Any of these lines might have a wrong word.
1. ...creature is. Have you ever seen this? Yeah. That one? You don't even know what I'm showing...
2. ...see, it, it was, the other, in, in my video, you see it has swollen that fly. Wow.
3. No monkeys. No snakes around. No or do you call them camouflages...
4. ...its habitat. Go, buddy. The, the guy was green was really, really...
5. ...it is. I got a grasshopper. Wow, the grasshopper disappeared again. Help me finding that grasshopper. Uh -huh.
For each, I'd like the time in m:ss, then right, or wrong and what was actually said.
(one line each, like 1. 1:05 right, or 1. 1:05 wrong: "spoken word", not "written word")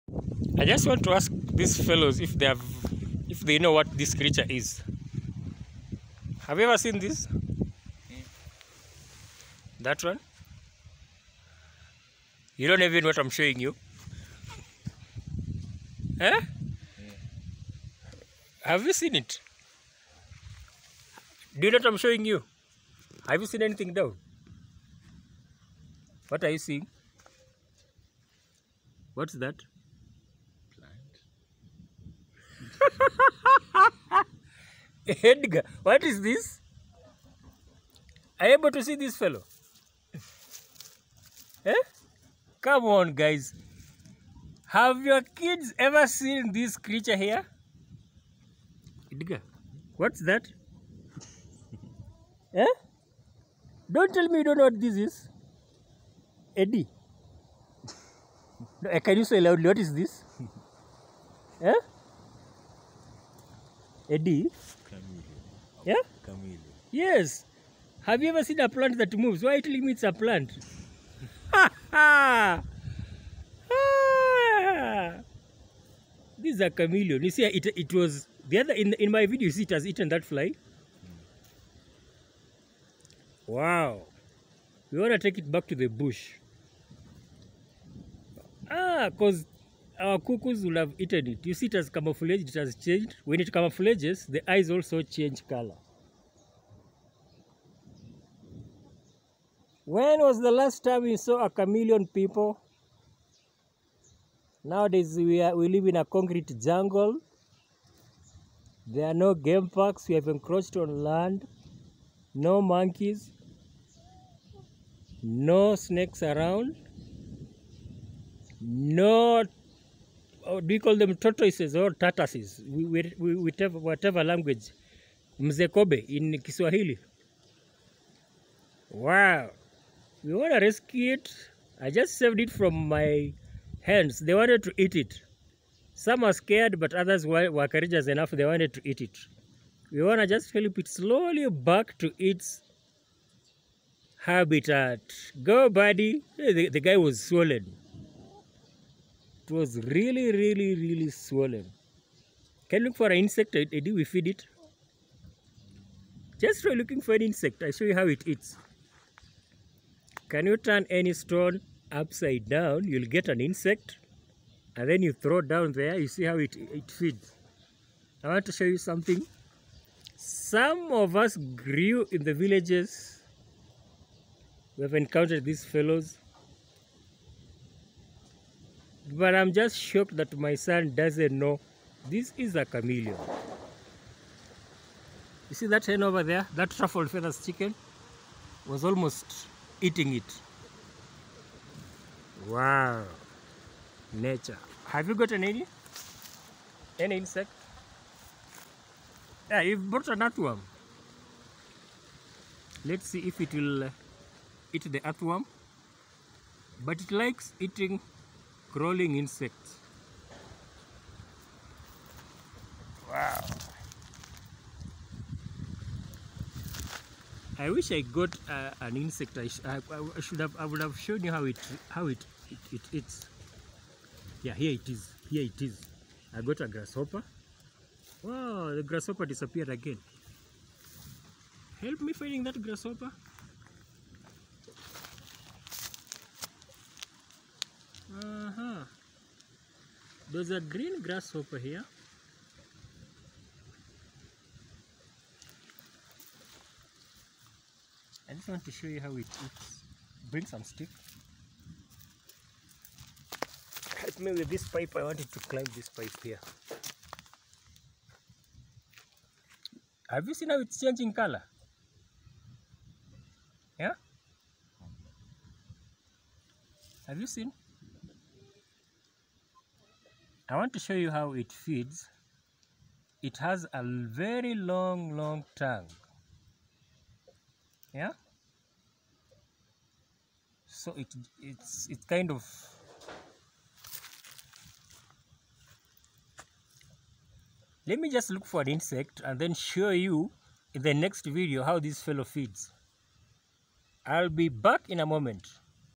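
1. 0:04 right
2. 1:17 wrong: "eaten", not "swollen"
3. 1:52 wrong: "tortoises", not "camouflages"
4. 2:22 wrong: "swollen", not "green"
5. 3:45 right.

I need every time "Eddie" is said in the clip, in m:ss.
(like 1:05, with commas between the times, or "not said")
0:56, 1:04.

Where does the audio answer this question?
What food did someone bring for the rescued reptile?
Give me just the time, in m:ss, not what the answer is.
3:20.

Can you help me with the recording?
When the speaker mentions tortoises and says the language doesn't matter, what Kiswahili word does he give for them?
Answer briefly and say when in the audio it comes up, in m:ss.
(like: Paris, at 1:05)
Mzee, at 2:05.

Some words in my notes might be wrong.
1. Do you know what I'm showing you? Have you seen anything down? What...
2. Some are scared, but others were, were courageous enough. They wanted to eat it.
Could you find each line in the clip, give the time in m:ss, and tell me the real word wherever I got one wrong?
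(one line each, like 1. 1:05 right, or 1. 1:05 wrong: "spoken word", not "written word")
1. 0:21 right
2. 2:15 right.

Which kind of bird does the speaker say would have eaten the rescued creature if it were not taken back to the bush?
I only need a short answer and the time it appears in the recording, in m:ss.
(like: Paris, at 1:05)
cuckoos, at 1:30.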